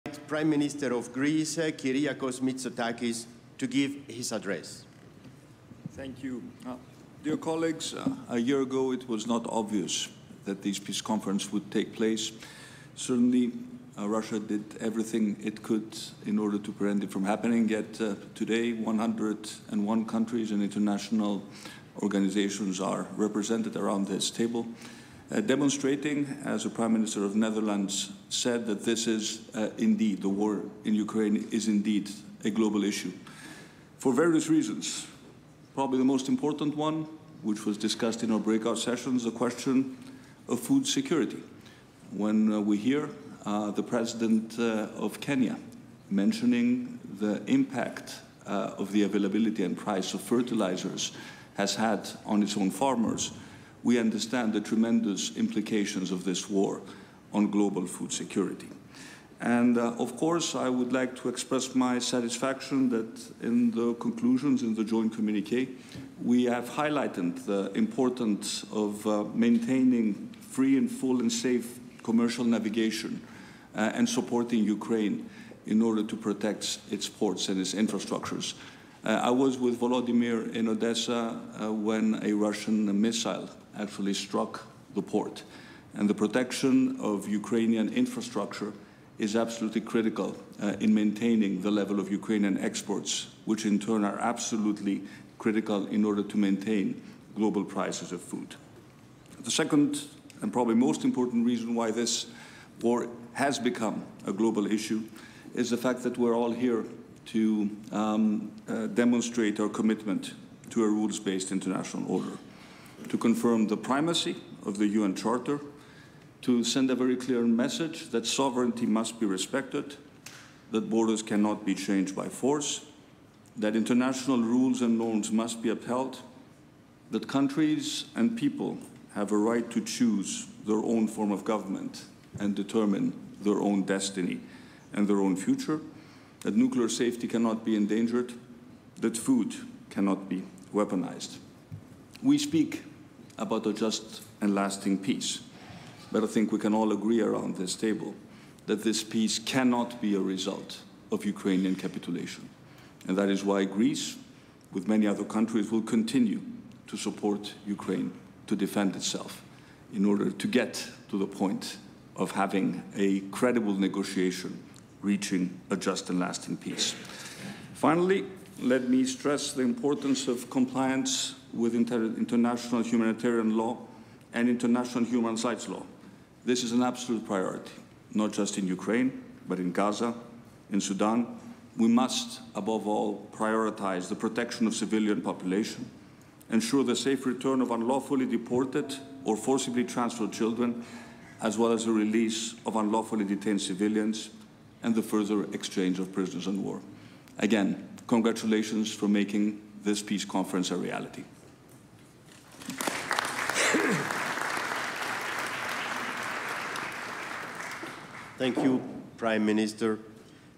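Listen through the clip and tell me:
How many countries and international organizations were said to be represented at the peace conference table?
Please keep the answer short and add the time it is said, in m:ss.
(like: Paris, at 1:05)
101, at 0:18.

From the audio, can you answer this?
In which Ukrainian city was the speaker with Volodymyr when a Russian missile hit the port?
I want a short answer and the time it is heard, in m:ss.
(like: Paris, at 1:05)
Odessa, at 1:20.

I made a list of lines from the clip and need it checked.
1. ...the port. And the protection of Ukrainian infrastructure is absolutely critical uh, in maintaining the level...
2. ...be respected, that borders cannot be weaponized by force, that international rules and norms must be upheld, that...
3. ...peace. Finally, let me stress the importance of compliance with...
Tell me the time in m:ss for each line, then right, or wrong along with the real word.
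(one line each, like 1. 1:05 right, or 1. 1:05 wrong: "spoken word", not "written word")
1. 1:24 right
2. 1:59 wrong: "changed", not "weaponized"
3. 2:46 right.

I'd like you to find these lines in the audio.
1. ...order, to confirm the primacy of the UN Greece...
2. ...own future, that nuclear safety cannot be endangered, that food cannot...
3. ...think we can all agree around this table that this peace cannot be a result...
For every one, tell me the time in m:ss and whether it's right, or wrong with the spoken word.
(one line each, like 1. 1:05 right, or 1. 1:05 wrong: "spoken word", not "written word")
1. 1:52 wrong: "Charter", not "Greece"
2. 2:15 right
3. 2:26 right.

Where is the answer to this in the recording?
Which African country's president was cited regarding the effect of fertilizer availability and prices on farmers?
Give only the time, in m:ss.
0:45.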